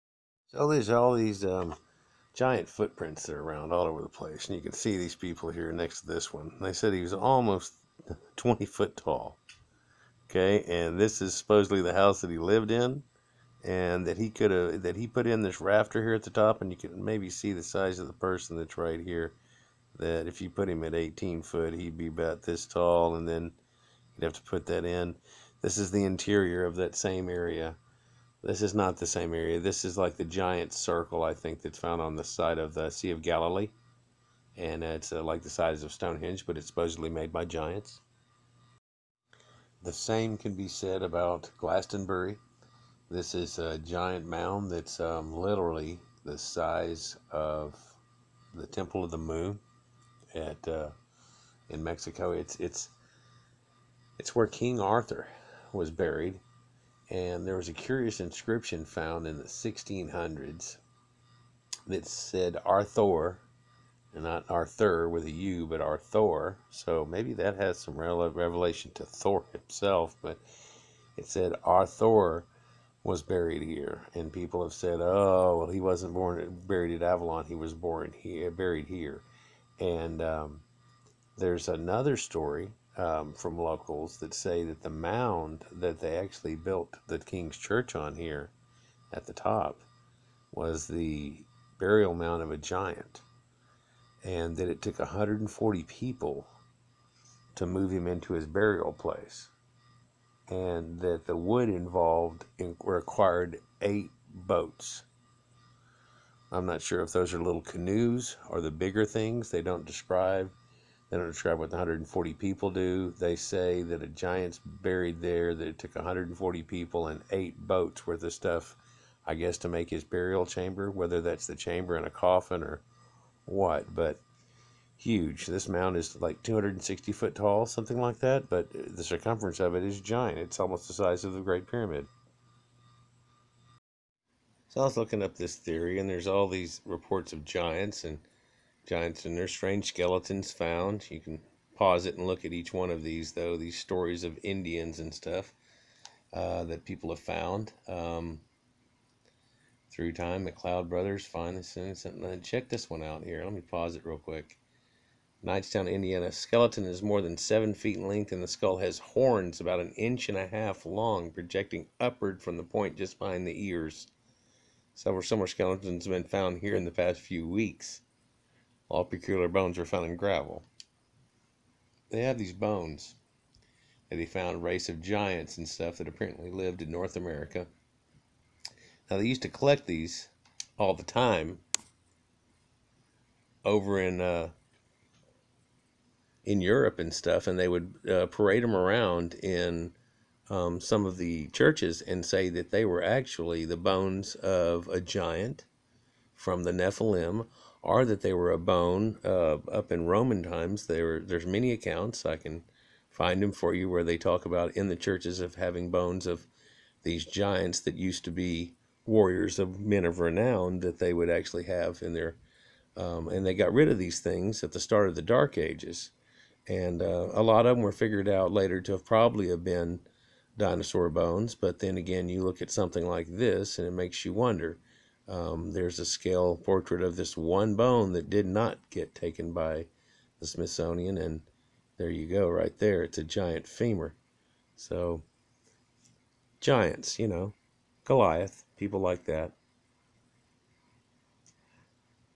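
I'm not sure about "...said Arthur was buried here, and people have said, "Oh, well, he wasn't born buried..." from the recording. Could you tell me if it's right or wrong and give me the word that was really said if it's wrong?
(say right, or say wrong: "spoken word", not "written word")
right.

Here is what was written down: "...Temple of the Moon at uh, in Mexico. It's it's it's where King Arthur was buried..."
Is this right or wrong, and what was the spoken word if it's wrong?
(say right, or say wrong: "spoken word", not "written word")
right.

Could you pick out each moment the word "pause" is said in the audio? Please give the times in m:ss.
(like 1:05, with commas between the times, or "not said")
2:21, 2:33.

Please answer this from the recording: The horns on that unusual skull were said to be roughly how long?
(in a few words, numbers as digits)
1.5 inches.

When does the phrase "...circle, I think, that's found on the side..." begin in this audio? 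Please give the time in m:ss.
0:30.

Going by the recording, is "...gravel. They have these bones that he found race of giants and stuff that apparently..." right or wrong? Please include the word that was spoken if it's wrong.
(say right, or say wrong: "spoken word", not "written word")
right.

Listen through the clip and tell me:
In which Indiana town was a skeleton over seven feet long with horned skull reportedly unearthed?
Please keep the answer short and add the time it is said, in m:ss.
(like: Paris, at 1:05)
Knightstown, at 2:35.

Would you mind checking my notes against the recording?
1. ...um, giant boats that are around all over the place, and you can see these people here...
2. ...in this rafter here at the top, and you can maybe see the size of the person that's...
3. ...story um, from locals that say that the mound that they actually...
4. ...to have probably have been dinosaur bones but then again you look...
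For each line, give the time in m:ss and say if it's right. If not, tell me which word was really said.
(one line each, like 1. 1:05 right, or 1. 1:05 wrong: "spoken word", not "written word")
1. 0:01 wrong: "footprints", not "boats"
2. 0:15 right
3. 1:22 right
4. 3:38 right.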